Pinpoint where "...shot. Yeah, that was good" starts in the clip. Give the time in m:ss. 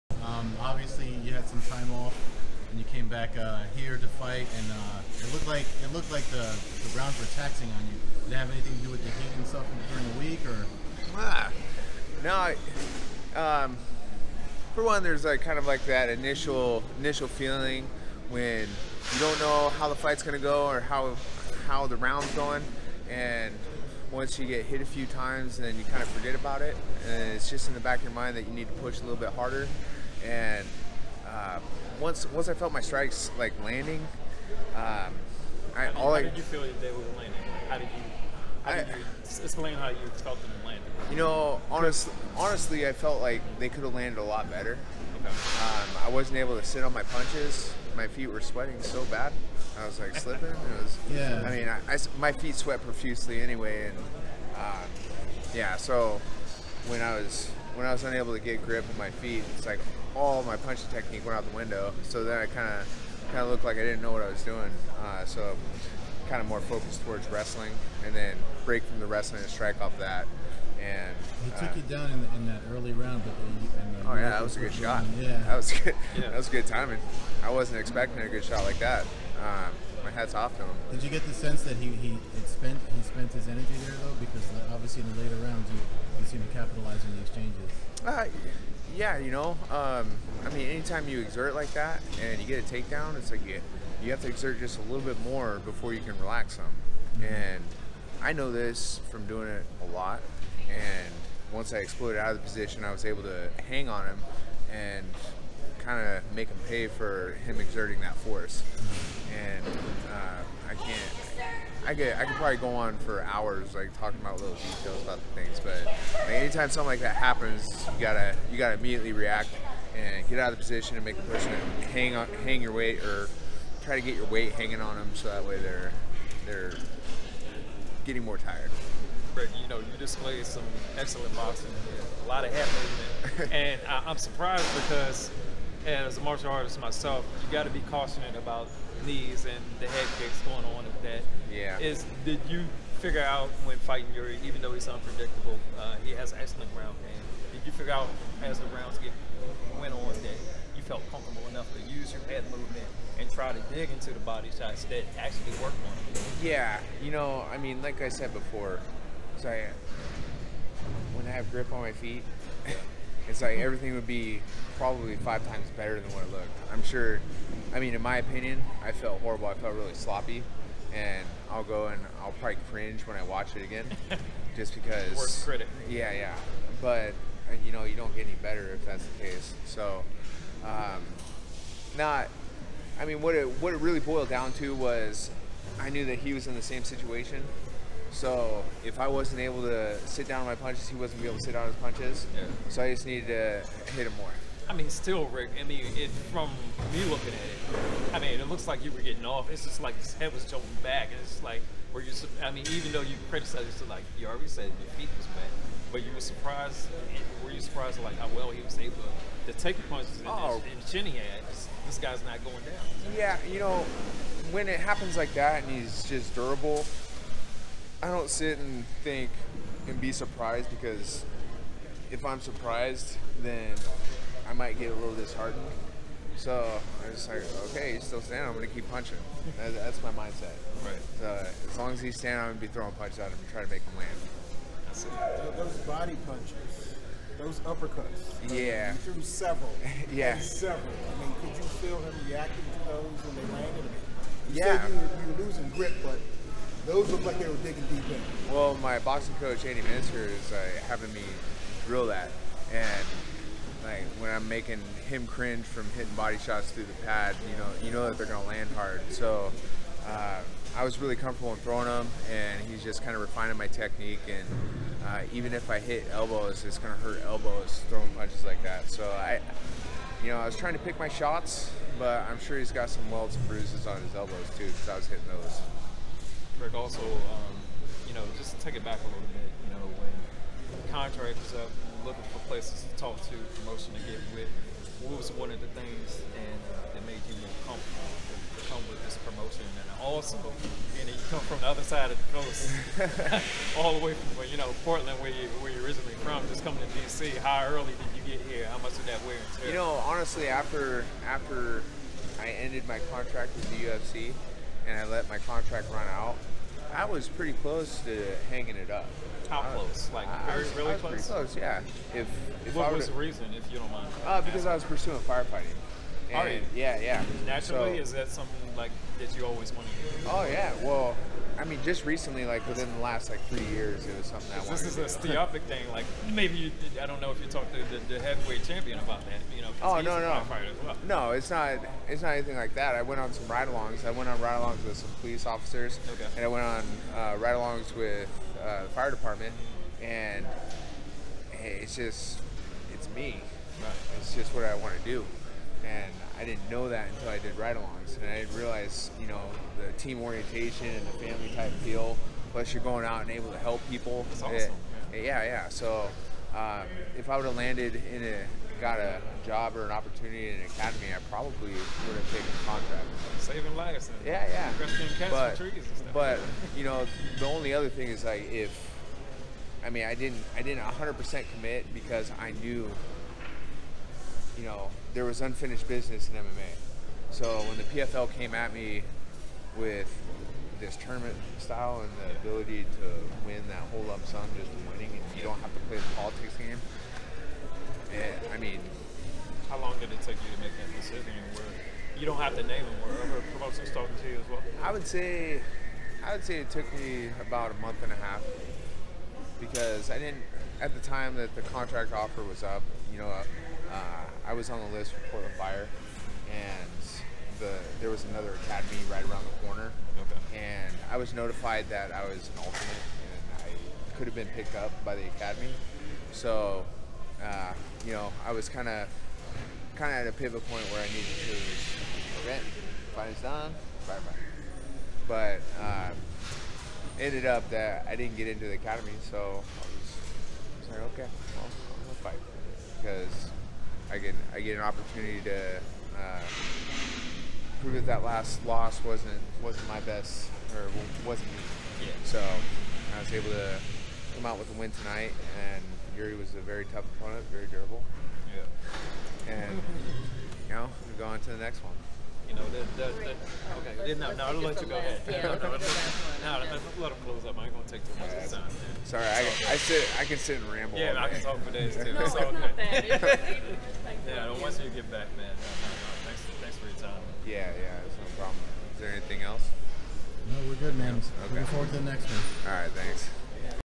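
1:14.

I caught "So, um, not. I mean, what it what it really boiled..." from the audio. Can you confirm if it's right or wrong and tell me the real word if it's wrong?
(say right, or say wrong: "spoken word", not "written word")
right.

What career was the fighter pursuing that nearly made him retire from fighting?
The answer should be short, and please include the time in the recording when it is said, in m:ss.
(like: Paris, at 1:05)
Firefighting, at 5:15.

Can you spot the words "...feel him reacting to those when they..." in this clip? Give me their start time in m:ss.
4:01.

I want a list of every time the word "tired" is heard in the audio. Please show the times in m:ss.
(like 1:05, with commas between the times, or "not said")
2:08.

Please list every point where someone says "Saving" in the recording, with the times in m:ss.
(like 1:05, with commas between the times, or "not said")
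6:03.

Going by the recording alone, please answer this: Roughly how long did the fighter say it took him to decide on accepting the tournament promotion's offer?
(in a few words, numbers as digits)
A month and a half.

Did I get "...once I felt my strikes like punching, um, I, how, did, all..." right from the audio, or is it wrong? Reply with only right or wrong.
wrong.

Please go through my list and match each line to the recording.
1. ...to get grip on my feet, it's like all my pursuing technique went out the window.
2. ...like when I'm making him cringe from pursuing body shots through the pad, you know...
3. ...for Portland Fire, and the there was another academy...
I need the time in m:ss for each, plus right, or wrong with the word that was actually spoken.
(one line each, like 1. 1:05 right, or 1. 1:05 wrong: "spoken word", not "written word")
1. 0:58 wrong: "punching", not "pursuing"
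2. 4:13 wrong: "hitting", not "pursuing"
3. 6:45 right.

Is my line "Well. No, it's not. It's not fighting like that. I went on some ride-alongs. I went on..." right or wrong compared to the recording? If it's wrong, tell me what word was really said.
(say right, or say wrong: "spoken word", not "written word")
wrong: "anything", not "fighting".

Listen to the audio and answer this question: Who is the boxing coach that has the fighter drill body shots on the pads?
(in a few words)
Andy Minister.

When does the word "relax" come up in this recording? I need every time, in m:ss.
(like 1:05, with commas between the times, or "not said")
1:36.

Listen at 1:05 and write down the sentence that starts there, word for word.
Uh, so kind of more focused towards wrestling, and then break from the wrestling and strike off that.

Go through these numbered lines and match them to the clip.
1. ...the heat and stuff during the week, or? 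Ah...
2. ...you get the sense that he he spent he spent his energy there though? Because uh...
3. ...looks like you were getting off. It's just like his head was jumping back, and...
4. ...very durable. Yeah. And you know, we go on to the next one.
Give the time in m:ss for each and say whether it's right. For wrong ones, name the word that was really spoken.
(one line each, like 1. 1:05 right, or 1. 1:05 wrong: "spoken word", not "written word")
1. 0:09 right
2. 1:21 right
3. 3:18 right
4. 7:27 right.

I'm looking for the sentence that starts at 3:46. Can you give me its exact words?
So I'm just like, okay, he's still standing.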